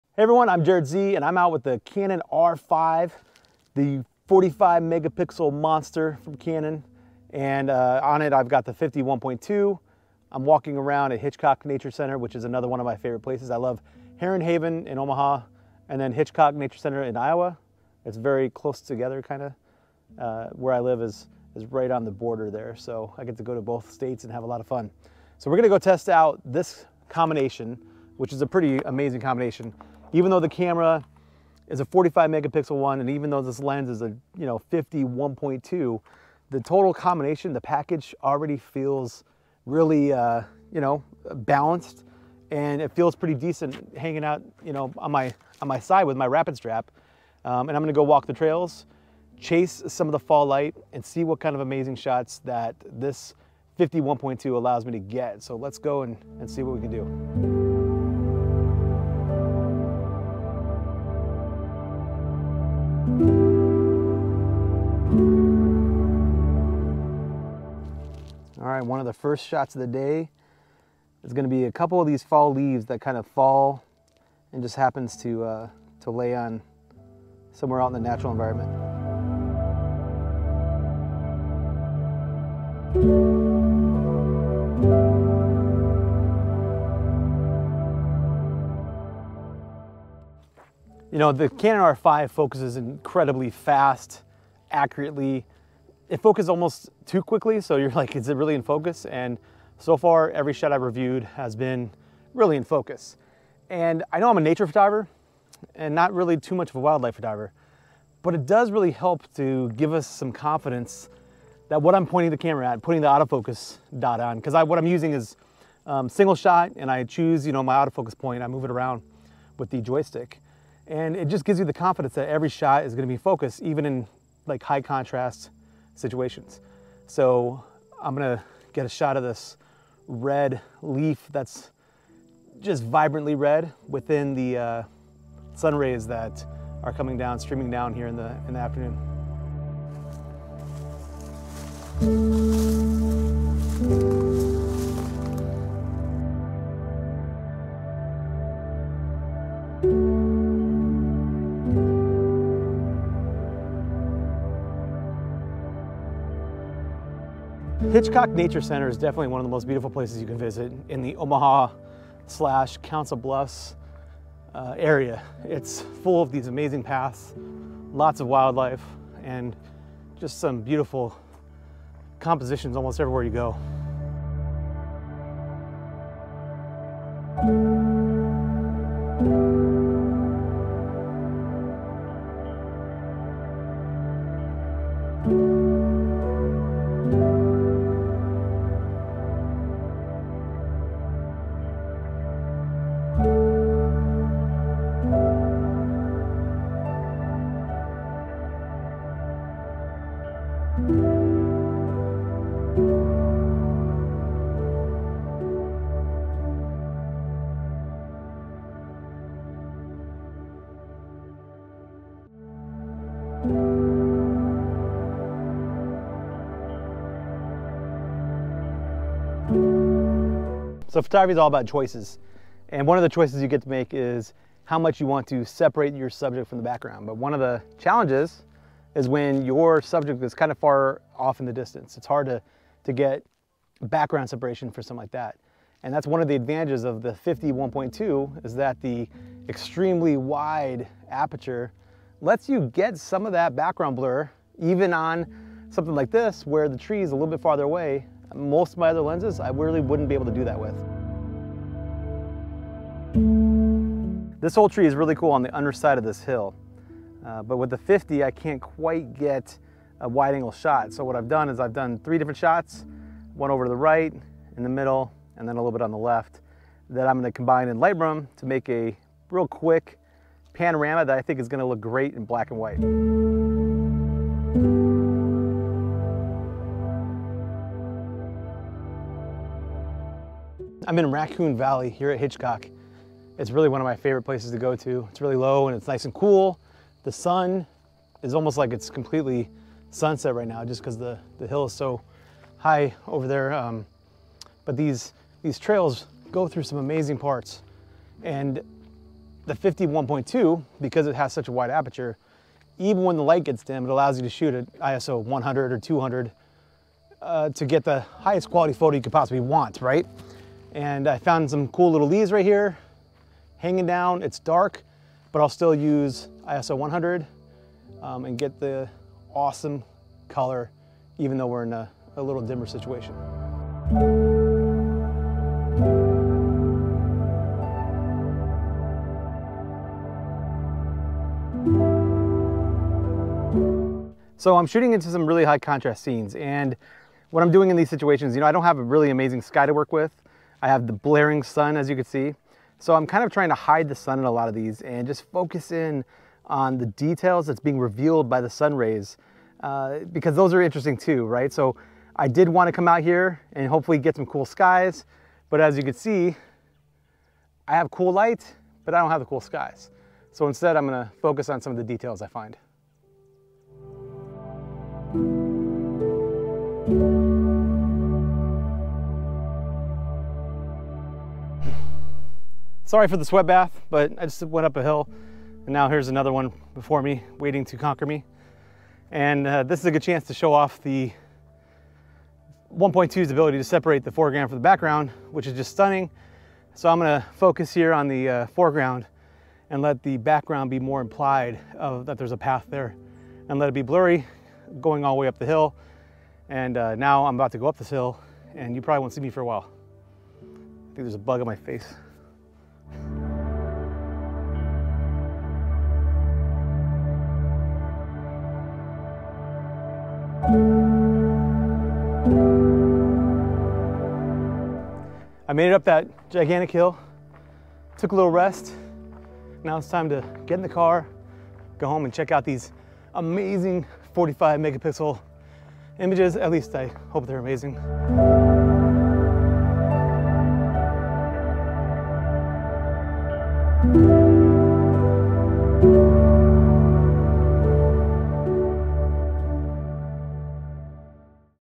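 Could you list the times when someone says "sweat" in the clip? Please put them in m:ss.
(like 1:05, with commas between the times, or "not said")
6:13.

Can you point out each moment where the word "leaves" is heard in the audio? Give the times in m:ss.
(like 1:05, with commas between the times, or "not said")
1:12, 5:12.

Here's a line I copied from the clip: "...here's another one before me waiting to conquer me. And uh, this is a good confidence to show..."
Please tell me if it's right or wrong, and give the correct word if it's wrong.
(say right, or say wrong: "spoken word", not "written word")
wrong: "chance", not "confidence".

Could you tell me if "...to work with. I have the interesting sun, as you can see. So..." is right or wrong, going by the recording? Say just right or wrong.
wrong.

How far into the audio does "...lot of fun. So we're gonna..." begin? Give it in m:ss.
0:24.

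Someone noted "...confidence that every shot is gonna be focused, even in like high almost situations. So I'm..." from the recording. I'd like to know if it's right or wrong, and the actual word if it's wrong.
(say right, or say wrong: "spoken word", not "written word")
wrong: "contrast", not "almost".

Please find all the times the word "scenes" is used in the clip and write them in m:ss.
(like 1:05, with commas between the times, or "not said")
5:36.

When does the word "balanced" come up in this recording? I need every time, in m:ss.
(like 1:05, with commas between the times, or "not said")
0:41.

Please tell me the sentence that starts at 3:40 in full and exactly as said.
So photography is all about choices.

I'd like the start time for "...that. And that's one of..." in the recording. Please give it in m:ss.
3:55.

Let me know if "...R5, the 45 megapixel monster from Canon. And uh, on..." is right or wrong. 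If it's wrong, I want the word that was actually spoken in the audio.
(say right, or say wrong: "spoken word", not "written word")
right.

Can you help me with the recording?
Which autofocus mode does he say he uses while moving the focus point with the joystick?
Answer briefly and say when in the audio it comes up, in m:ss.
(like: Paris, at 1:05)
Single shot, at 1:56.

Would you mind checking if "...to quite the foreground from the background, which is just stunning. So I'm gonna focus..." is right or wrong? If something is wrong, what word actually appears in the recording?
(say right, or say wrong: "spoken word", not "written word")
wrong: "separate", not "quite".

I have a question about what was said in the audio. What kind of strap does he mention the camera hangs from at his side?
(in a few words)
Rapid strap.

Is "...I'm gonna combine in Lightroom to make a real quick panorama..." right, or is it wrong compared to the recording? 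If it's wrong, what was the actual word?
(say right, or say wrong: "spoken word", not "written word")
right.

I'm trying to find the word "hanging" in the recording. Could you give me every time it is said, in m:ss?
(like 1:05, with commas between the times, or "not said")
0:43, 5:13.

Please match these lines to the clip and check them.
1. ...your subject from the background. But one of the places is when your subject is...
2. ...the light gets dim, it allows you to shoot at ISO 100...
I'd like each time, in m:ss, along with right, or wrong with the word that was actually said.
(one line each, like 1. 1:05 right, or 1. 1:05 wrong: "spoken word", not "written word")
1. 3:45 wrong: "challenges", not "places"
2. 5:03 right.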